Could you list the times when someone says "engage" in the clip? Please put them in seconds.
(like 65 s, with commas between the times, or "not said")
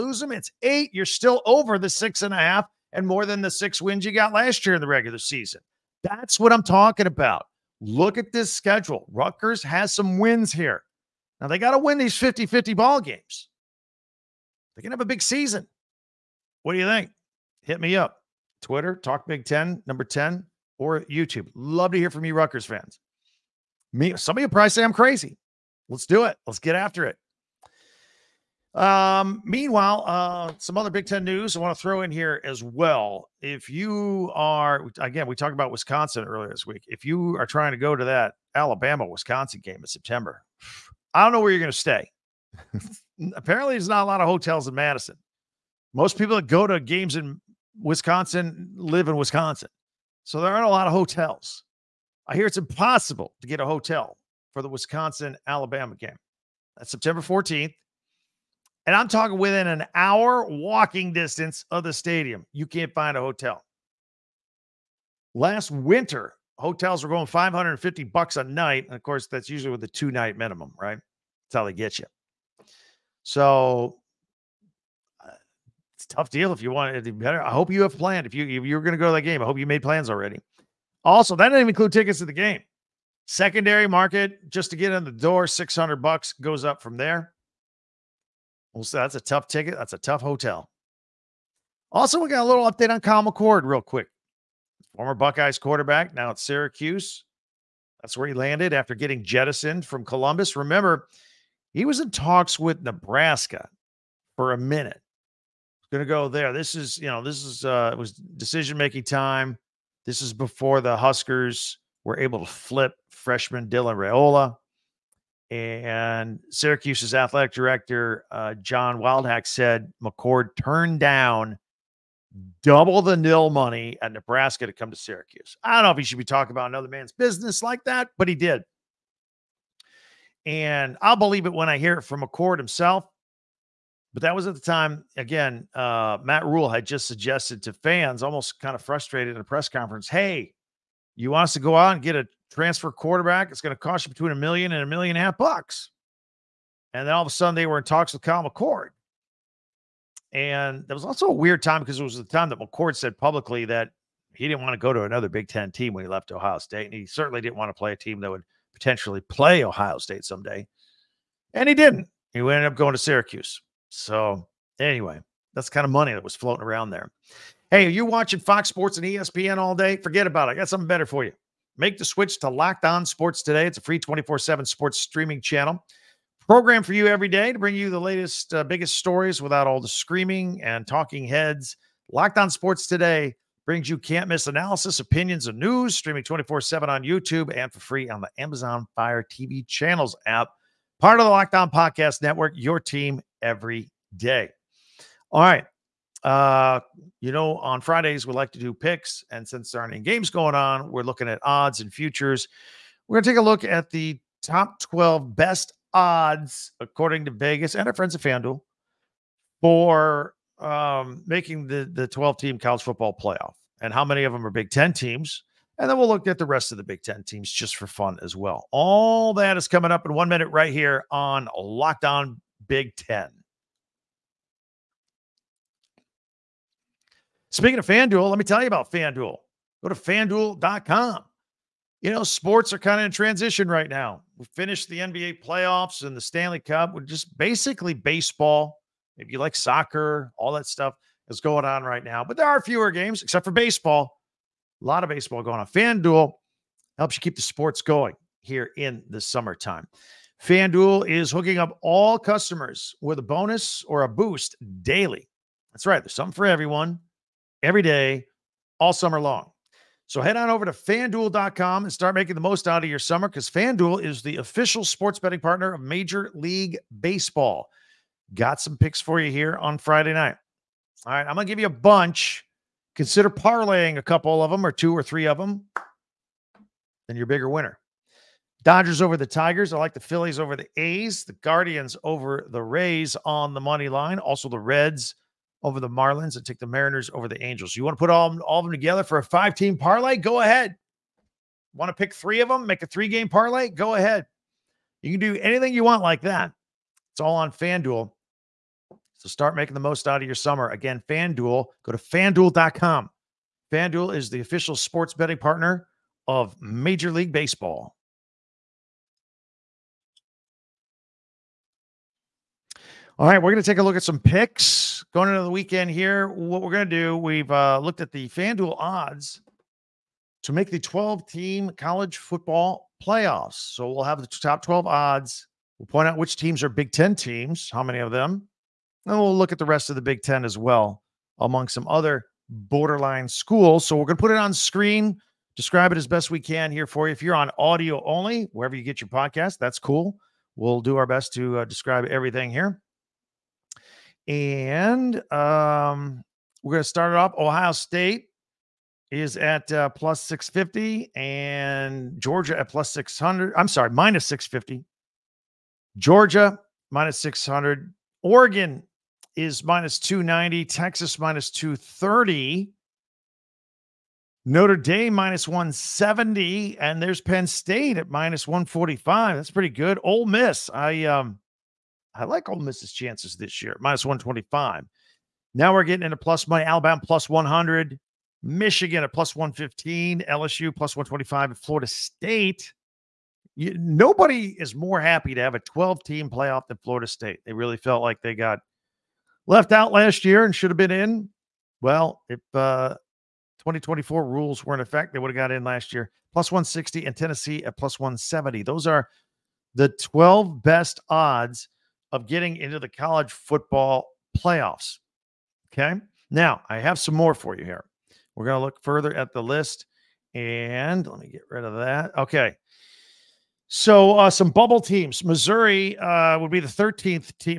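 not said.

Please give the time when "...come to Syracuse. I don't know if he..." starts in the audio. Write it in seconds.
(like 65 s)
124 s.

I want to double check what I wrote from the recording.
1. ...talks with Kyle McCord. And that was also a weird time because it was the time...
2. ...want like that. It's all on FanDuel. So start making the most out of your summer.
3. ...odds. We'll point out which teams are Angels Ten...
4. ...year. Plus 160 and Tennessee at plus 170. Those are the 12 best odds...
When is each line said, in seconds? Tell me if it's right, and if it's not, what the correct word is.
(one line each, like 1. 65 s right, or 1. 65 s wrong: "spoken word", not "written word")
1. 147 s right
2. 295 s right
3. 324 s wrong: "Big", not "Angels"
4. 395 s right.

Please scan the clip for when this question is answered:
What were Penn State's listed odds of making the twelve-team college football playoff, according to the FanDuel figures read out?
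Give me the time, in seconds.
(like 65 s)
368 s.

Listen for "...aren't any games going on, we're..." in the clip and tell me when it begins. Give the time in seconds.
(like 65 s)
199 s.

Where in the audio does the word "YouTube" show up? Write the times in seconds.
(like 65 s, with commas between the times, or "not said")
21 s, 187 s.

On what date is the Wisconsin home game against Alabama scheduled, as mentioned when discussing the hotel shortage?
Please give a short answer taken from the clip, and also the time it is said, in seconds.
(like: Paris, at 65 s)
September 14th, at 56 s.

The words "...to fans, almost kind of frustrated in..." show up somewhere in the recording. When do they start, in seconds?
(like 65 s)
137 s.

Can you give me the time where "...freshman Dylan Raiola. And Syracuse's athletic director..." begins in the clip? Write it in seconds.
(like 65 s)
113 s.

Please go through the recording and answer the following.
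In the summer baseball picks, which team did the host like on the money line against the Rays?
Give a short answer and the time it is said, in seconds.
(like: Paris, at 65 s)
Guardians, at 281 s.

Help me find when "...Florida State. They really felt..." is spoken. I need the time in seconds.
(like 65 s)
386 s.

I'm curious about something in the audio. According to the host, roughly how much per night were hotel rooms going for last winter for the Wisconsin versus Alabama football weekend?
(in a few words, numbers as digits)
$550.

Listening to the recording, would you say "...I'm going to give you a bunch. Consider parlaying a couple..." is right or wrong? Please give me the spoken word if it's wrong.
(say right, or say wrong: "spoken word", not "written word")
right.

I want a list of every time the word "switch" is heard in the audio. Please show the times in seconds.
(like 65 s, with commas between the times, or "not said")
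172 s.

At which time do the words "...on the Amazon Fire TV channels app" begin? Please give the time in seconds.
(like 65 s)
188 s.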